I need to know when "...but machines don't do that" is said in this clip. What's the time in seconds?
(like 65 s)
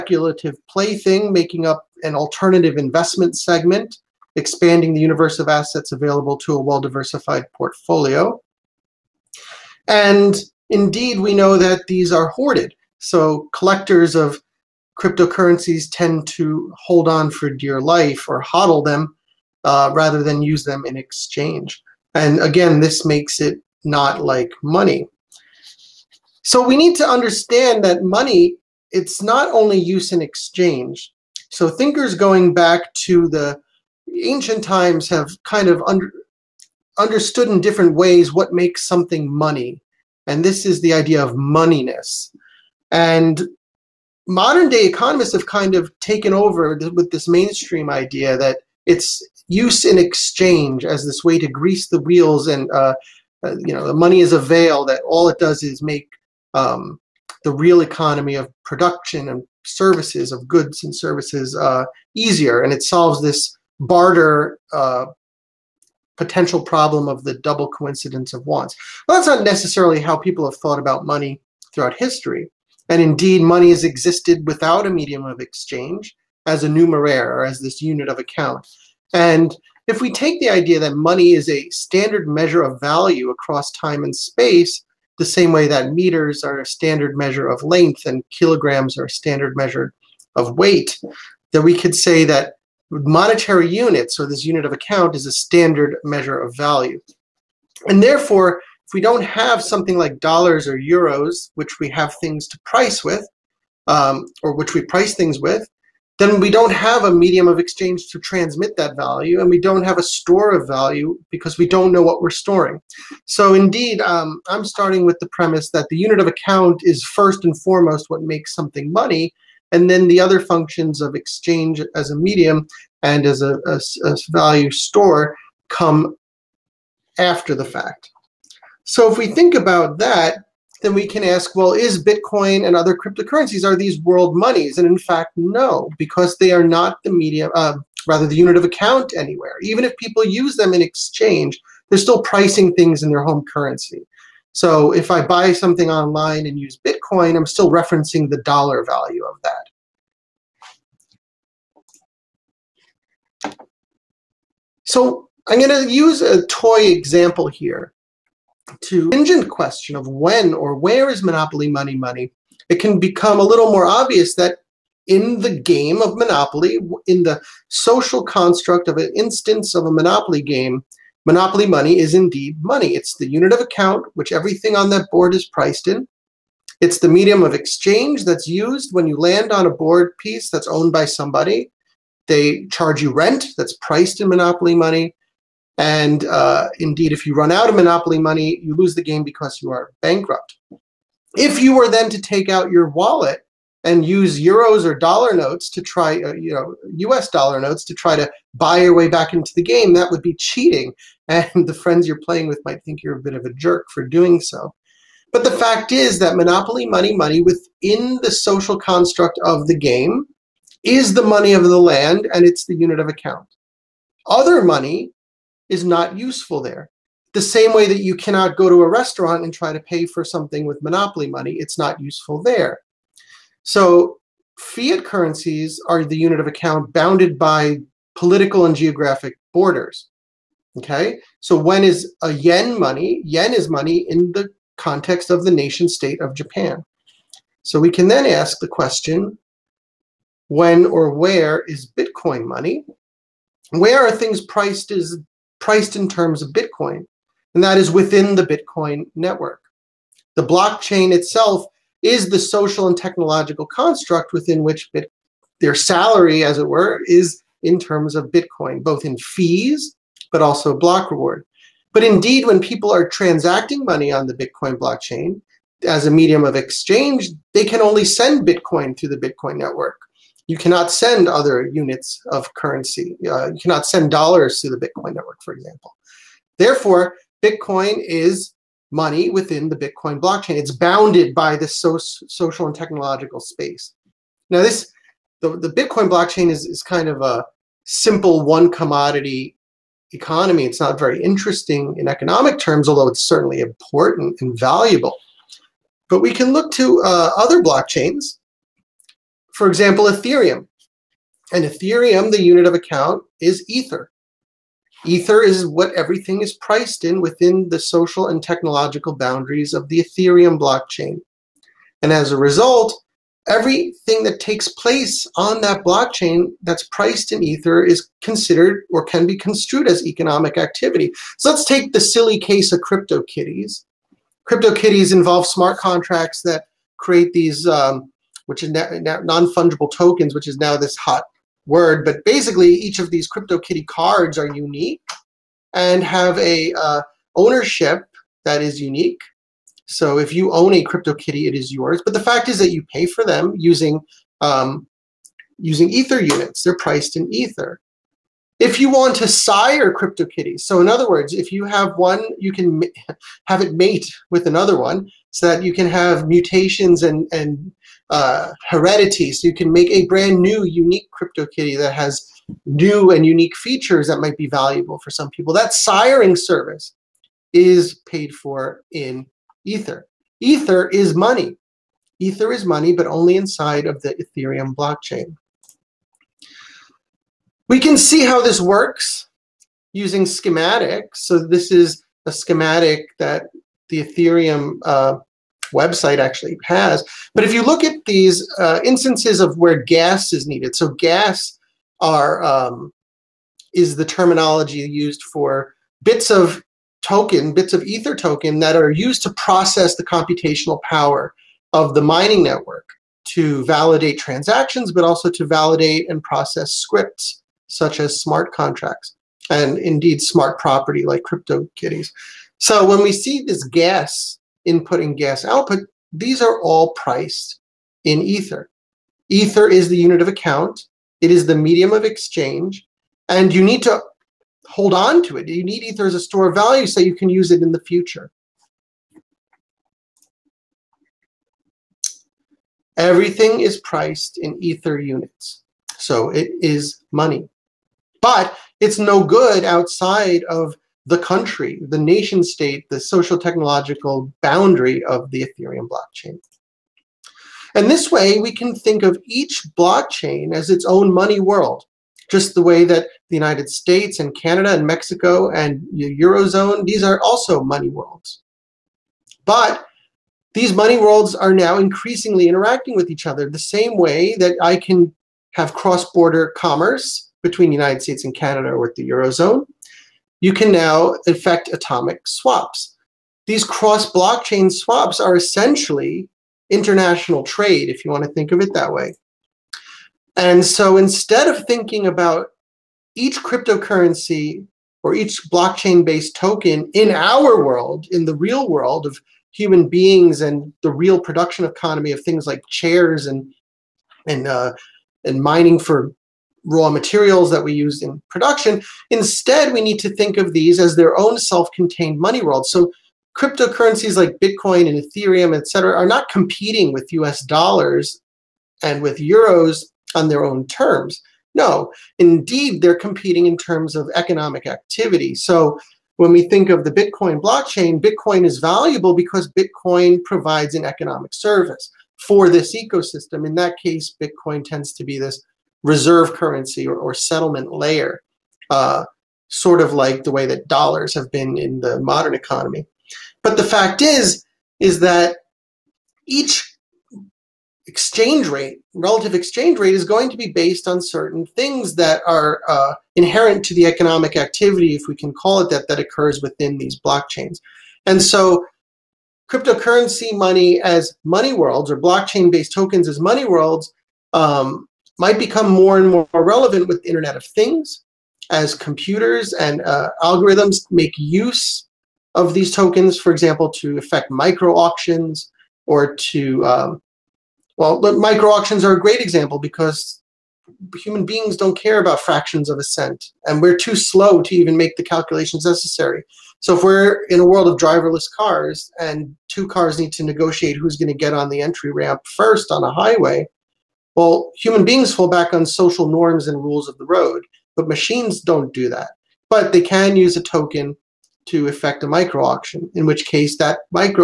587 s.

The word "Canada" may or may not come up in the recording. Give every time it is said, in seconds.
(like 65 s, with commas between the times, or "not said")
454 s, 468 s.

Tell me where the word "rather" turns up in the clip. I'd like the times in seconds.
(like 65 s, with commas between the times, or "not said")
19 s, 138 s.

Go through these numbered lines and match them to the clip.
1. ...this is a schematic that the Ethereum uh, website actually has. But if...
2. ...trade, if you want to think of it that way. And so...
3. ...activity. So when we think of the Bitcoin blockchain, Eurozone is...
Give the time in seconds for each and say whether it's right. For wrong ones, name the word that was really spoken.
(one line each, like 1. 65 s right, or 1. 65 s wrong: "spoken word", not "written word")
1. 381 s right
2. 477 s right
3. 514 s wrong: "Bitcoin", not "Eurozone".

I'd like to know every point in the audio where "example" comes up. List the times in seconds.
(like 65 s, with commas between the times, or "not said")
156 s, 275 s, 299 s, 563 s, 569 s.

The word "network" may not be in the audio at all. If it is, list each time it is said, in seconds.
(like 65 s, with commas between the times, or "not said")
249 s, 269 s, 275 s, 402 s.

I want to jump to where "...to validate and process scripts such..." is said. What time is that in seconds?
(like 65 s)
405 s.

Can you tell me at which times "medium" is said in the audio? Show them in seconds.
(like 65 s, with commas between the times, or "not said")
74 s, 107 s, 122 s, 137 s, 177 s, 266 s, 421 s.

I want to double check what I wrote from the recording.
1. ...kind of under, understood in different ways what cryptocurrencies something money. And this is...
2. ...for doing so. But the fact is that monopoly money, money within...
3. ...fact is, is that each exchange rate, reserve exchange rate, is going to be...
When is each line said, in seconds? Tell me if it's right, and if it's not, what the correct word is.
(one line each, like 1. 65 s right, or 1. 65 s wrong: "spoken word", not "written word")
1. 35 s wrong: "makes", not "cryptocurrencies"
2. 203 s right
3. 533 s wrong: "relative", not "reserve".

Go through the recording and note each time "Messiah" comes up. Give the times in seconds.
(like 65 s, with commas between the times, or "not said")
not said.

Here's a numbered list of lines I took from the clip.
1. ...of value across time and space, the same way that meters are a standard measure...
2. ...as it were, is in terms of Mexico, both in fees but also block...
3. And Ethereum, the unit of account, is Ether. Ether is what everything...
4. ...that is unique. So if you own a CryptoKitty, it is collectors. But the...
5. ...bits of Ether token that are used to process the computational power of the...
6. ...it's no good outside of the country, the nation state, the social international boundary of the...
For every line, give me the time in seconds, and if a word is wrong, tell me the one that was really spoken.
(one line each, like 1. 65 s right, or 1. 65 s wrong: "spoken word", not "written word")
1. 82 s right
2. 256 s wrong: "Bitcoin", not "Mexico"
3. 301 s right
4. 338 s wrong: "yours", not "collectors"
5. 397 s right
6. 438 s wrong: "technological", not "international".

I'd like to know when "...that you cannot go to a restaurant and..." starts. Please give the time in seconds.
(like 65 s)
217 s.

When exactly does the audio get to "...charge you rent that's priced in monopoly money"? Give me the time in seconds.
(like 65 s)
182 s.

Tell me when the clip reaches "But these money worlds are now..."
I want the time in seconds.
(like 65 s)
459 s.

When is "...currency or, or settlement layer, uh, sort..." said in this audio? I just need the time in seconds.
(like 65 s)
526 s.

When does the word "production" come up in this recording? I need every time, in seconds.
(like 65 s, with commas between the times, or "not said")
58 s, 491 s, 498 s.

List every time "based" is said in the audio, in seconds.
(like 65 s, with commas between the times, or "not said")
486 s, 540 s, 552 s.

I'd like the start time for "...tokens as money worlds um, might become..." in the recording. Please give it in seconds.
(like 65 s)
552 s.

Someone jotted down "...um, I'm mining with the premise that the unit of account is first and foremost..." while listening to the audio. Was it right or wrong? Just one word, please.
wrong.